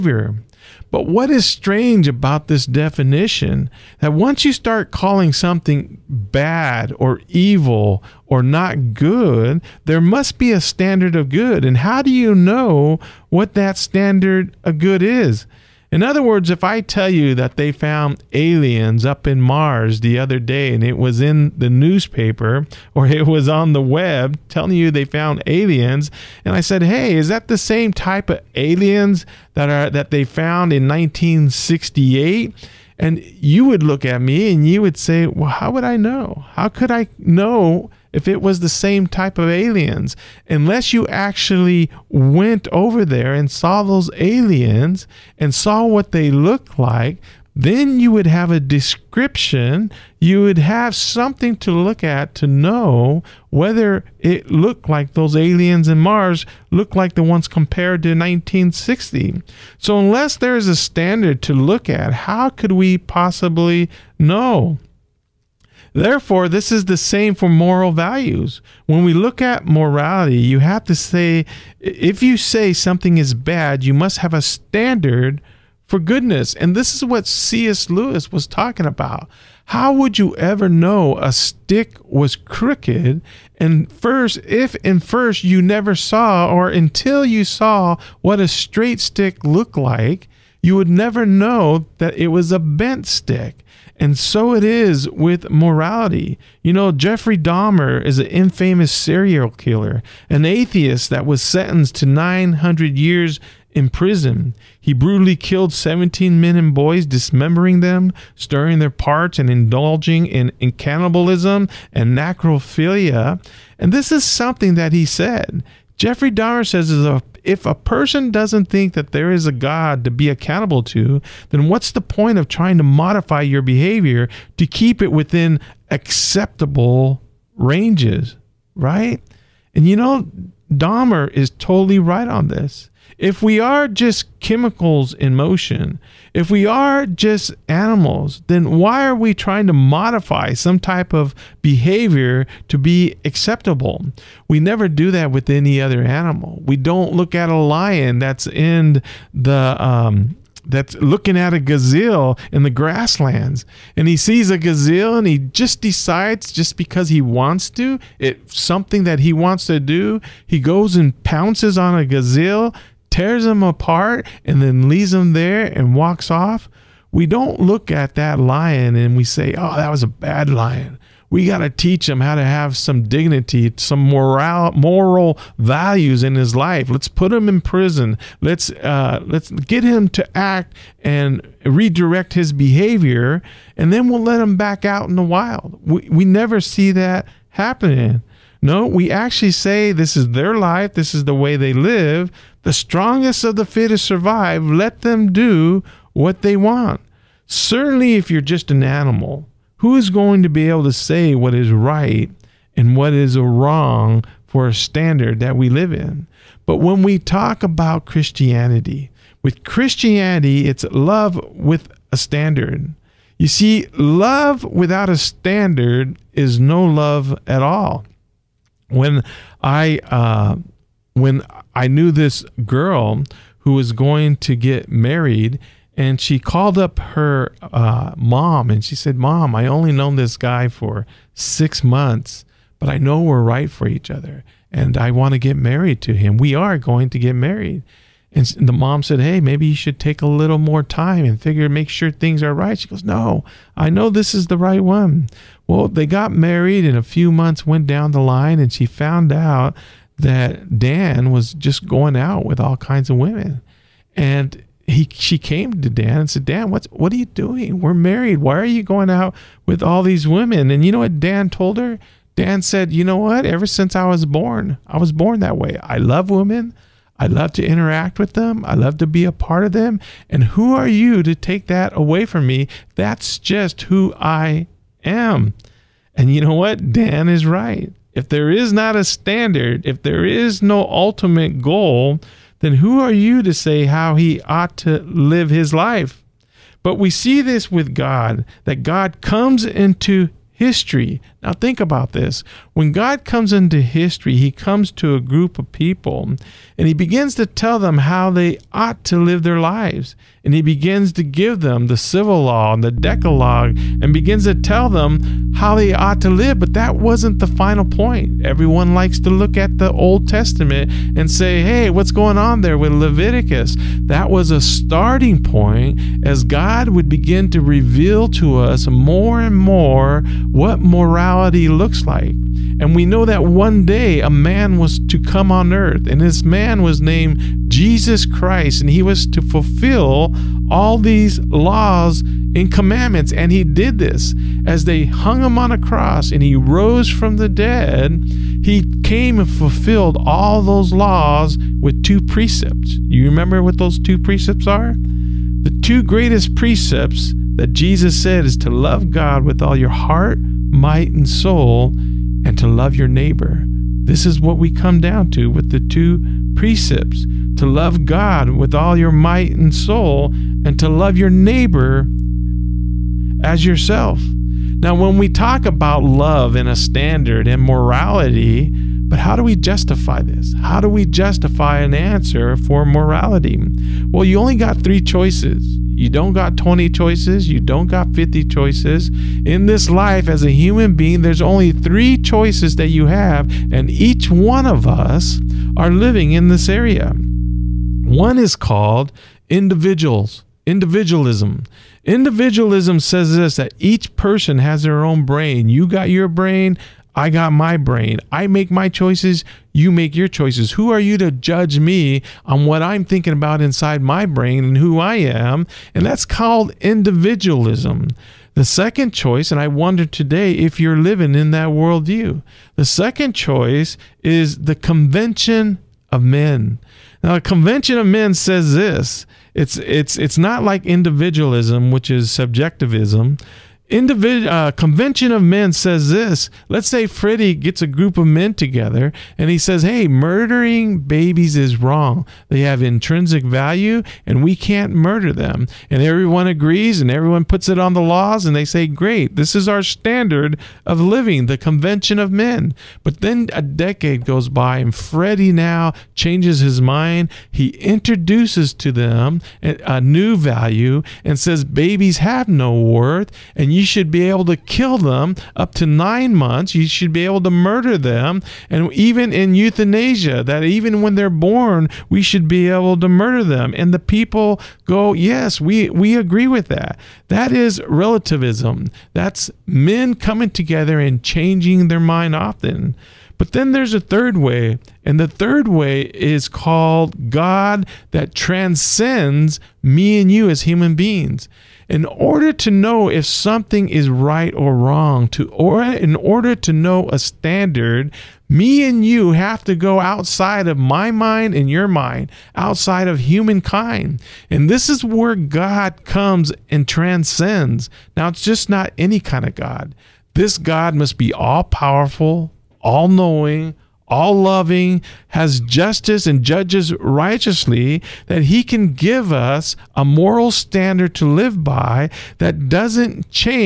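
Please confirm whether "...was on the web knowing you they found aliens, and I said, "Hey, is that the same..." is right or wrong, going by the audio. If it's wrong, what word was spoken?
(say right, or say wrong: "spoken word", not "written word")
wrong: "telling", not "knowing".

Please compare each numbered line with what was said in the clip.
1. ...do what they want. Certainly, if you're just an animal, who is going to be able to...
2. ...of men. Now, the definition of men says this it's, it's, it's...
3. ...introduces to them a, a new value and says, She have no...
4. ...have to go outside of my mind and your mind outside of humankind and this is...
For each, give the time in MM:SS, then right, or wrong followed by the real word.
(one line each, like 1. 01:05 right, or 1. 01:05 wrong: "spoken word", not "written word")
1. 03:15 right
2. 06:56 wrong: "convention", not "definition"
3. 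07:27 wrong: "Babies", not "She"
4. 08:09 right.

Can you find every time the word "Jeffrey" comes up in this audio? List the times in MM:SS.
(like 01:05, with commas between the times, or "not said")
01:36, 01:55.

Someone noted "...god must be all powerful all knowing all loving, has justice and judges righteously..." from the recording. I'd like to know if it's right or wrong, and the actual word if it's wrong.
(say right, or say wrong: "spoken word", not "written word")
right.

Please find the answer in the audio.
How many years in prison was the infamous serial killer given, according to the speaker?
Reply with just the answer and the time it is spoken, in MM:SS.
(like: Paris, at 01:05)
900 years, at 01:42.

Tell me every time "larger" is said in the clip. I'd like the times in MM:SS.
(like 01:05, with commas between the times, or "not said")
not said.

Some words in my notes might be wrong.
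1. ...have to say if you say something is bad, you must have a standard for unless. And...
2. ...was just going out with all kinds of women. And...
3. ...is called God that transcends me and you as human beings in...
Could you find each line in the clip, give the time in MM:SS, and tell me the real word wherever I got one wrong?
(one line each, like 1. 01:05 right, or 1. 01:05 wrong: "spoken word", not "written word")
1. 01:10 wrong: "goodness", not "unless"
2. 04:11 right
3. 07:56 right.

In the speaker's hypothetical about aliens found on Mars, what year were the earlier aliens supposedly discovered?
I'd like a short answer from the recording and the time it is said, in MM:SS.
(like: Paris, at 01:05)
1968, at 00:30.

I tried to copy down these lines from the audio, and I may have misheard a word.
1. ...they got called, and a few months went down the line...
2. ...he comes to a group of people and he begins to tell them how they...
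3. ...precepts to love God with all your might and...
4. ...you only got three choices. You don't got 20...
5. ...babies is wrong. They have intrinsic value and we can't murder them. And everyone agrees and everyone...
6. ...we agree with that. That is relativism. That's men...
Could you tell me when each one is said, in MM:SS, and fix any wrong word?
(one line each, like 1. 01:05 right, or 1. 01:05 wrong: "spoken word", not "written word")
1. 04:05 wrong: "married", not "called"
2. 04:54 right
3. 05:56 right
4. 06:14 right
5. 07:11 right
6. 07:45 right.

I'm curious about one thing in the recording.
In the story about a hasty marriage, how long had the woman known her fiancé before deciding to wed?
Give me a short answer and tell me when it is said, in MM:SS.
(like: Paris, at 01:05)
six months, at 03:51.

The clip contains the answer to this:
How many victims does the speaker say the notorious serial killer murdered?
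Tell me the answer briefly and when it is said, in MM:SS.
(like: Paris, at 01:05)
17, at 01:45.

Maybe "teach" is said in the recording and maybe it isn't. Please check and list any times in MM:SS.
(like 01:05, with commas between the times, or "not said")
02:51.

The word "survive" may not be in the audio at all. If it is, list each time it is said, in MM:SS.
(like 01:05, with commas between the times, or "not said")
03:14.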